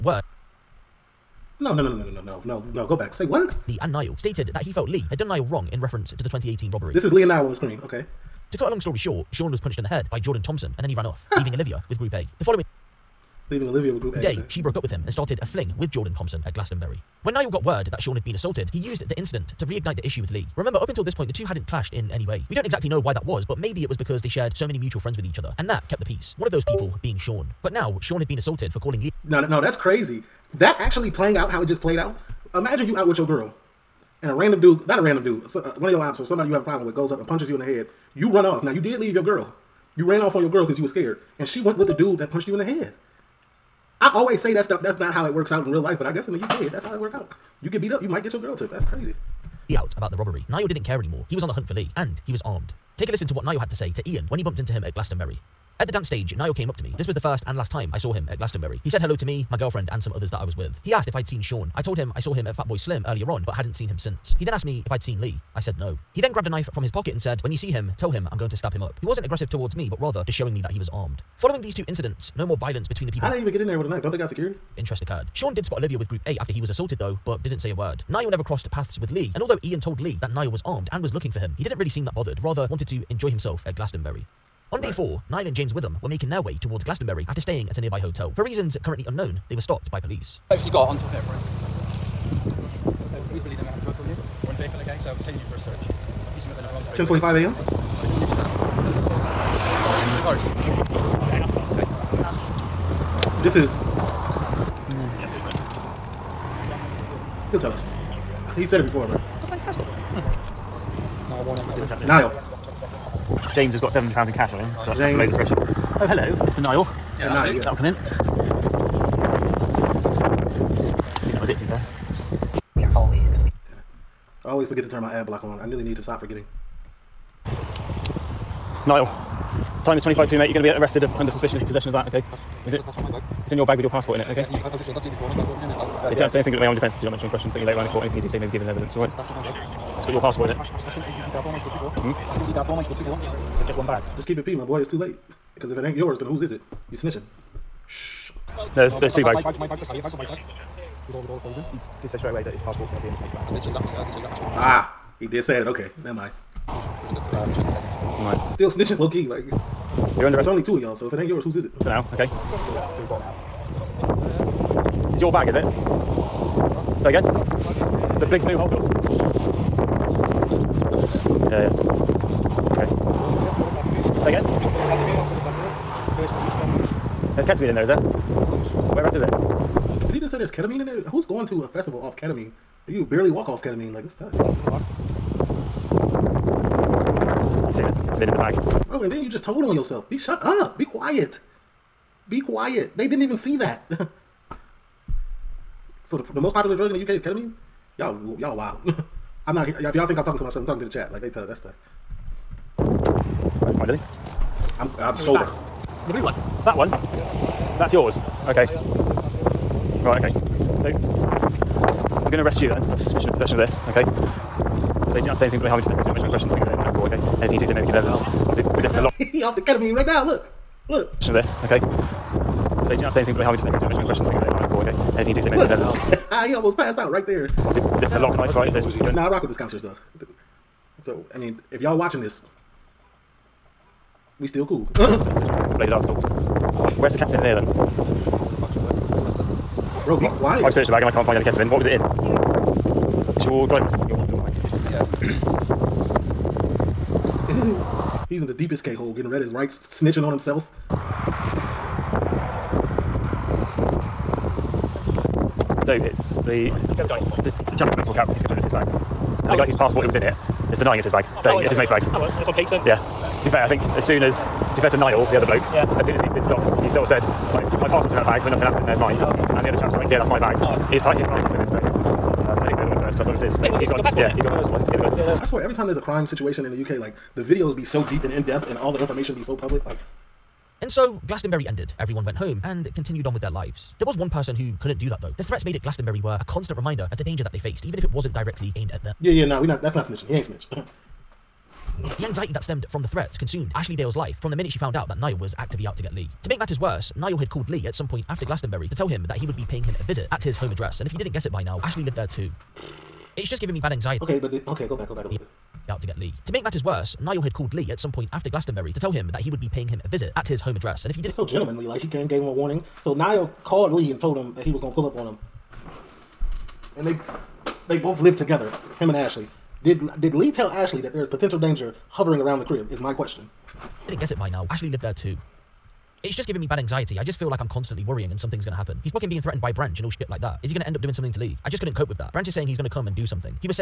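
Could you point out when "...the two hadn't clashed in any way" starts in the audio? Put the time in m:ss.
0:21.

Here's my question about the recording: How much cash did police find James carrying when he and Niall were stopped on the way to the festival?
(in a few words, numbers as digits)
£700.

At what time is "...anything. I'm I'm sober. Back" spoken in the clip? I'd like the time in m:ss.
3:23.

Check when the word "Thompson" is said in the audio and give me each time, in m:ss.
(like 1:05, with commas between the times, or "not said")
0:10, 0:16.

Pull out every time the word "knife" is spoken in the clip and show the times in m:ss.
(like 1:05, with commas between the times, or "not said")
1:06, 1:13, 3:48.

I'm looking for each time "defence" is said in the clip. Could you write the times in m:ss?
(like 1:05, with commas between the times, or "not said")
2:16, 3:35, 3:43.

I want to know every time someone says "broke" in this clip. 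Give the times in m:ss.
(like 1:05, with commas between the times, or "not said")
0:14.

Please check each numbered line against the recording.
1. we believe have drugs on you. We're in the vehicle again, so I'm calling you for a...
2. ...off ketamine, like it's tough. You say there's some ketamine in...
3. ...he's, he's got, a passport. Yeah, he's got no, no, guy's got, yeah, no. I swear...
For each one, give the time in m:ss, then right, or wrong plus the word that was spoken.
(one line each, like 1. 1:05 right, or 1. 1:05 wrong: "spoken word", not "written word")
1. 1:33 wrong: "taking", not "calling"
2. 3:03 right
3. 4:33 right.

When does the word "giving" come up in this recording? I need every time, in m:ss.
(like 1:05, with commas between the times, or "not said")
5:03, 5:26.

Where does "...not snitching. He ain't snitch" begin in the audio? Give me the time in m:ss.
4:49.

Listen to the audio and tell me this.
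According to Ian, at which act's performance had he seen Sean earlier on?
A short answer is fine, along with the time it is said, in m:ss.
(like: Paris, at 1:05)
Fatboy Slim, at 1:02.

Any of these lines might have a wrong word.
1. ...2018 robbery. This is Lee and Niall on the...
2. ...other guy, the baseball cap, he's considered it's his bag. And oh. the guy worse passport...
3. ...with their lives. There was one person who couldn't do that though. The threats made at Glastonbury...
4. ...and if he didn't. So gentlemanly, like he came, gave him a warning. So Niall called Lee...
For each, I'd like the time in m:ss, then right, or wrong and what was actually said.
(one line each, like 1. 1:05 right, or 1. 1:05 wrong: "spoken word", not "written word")
1. 0:06 right
2. 4:17 wrong: "whose", not "worse"
3. 4:43 right
4. 5:11 right.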